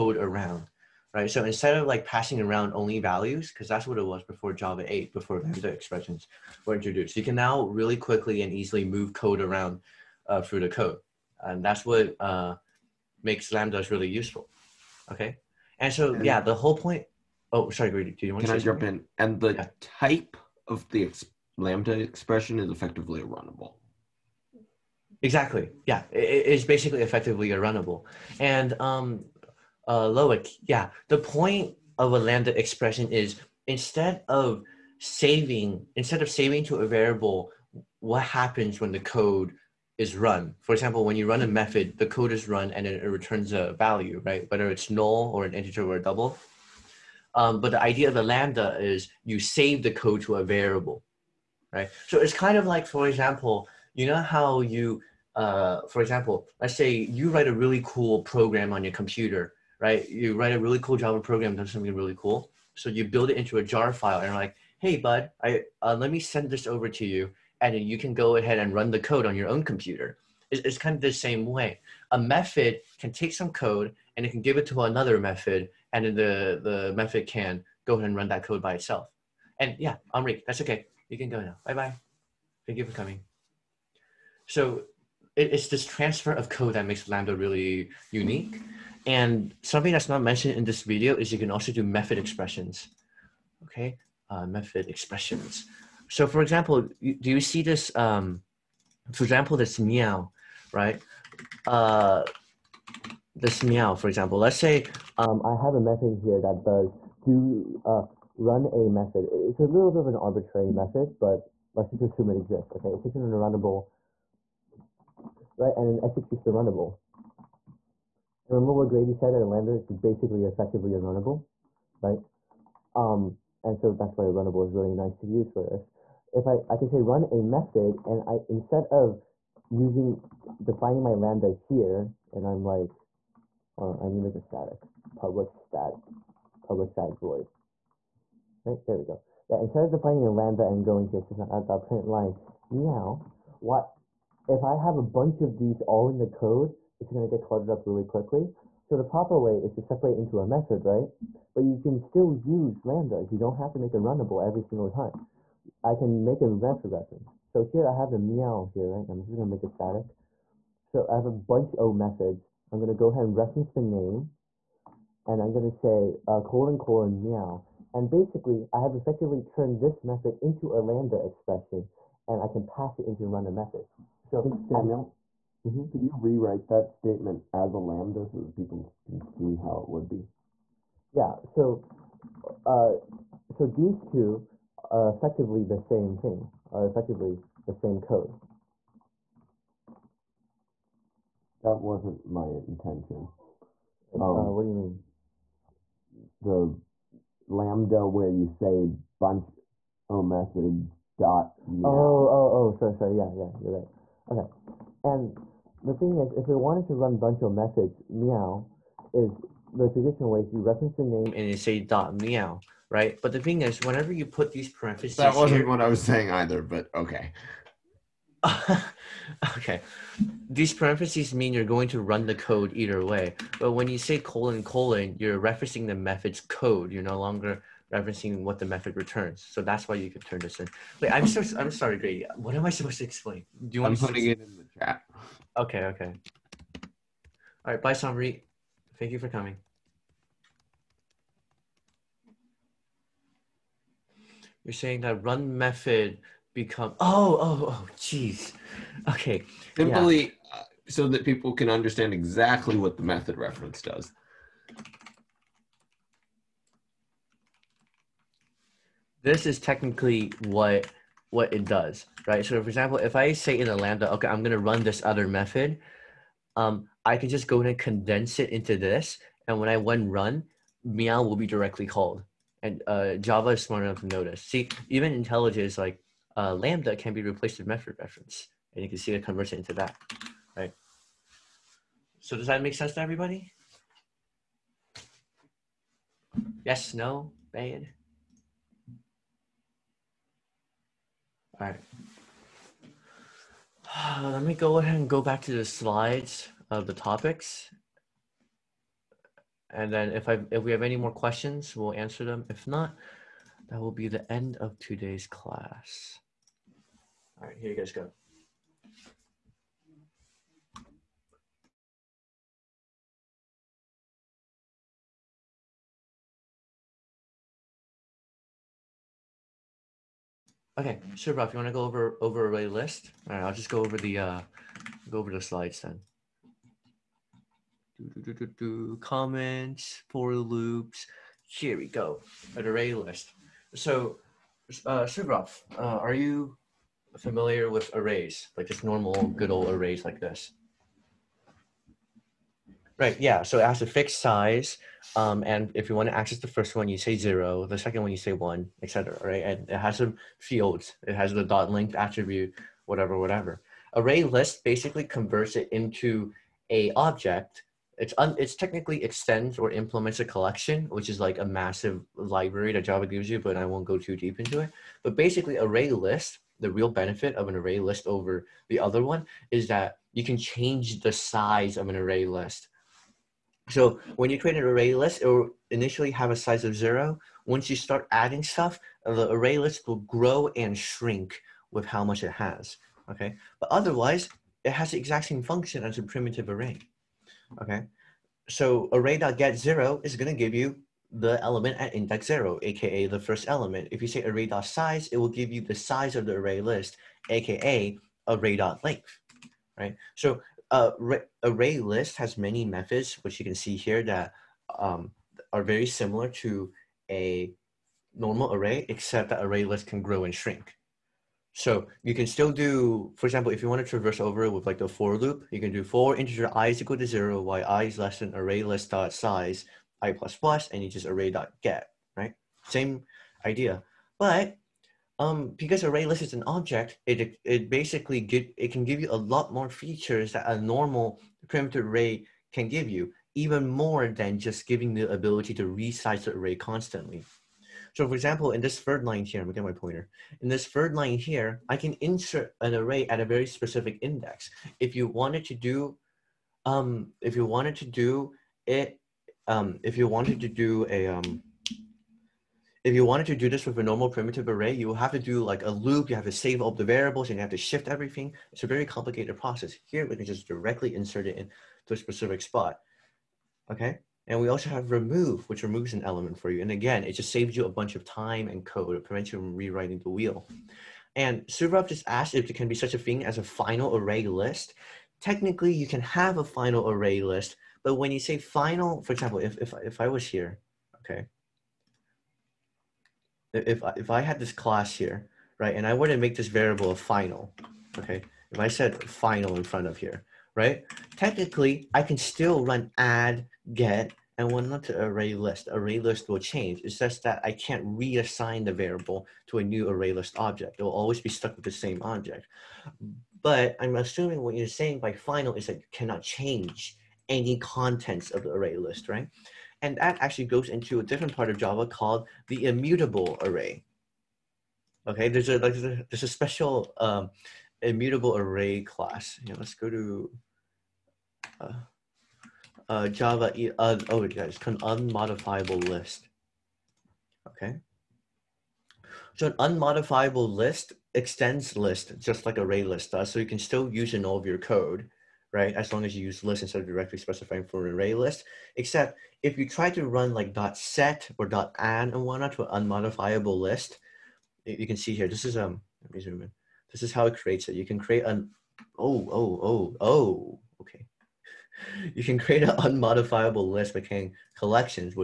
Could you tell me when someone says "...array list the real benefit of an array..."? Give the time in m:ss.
6:05.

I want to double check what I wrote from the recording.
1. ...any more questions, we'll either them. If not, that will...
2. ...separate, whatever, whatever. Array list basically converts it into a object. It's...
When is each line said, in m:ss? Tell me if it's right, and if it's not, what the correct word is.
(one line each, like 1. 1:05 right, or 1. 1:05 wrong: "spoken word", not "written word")
1. 5:00 wrong: "answer", not "either"
2. 5:51 wrong: "attribute", not "separate".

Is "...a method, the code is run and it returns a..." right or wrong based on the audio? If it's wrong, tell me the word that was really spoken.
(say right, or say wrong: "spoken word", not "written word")
right.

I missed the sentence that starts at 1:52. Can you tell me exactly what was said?
Okay, it takes in a runnable, right, and it executes the runnable.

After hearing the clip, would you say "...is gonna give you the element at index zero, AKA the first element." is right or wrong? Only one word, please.
right.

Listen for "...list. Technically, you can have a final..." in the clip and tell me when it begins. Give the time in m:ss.
7:54.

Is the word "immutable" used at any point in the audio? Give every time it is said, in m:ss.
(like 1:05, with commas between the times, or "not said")
8:32, 8:37.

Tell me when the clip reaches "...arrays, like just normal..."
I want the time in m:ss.
5:37.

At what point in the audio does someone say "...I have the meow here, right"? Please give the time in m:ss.
2:37.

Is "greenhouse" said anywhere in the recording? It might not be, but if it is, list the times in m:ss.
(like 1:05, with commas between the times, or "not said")
not said.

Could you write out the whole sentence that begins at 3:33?
But the thing is, whenever you put these parentheses.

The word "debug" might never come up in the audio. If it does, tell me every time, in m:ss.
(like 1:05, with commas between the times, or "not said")
not said.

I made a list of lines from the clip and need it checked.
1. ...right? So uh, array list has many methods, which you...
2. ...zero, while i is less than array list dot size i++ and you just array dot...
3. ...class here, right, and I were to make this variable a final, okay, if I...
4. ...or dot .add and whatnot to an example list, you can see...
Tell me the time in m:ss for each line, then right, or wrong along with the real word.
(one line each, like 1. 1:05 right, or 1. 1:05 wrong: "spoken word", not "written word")
1. 6:39 right
2. 6:57 right
3. 8:04 right
4. 9:01 wrong: "unmodifiable", not "example".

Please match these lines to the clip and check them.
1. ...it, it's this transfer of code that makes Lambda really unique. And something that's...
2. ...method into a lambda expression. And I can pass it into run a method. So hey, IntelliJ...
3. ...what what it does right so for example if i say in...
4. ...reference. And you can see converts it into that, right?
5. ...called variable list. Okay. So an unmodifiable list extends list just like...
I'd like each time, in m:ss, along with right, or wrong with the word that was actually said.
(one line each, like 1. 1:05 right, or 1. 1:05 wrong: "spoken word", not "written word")
1. 1:25 right
2. 2:50 wrong: "Samuel", not "IntelliJ"
3. 4:20 right
4. 4:37 right
5. 8:44 wrong: "unmodifiable", not "variable".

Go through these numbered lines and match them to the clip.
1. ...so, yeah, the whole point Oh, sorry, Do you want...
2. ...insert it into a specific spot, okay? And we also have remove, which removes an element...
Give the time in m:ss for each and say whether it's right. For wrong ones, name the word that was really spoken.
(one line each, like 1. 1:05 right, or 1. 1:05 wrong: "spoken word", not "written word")
1. 0:15 right
2. 7:40 right.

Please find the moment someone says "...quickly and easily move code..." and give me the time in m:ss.
0:07.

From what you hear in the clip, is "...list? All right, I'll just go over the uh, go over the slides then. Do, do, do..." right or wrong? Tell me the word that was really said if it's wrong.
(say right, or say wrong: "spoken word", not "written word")
right.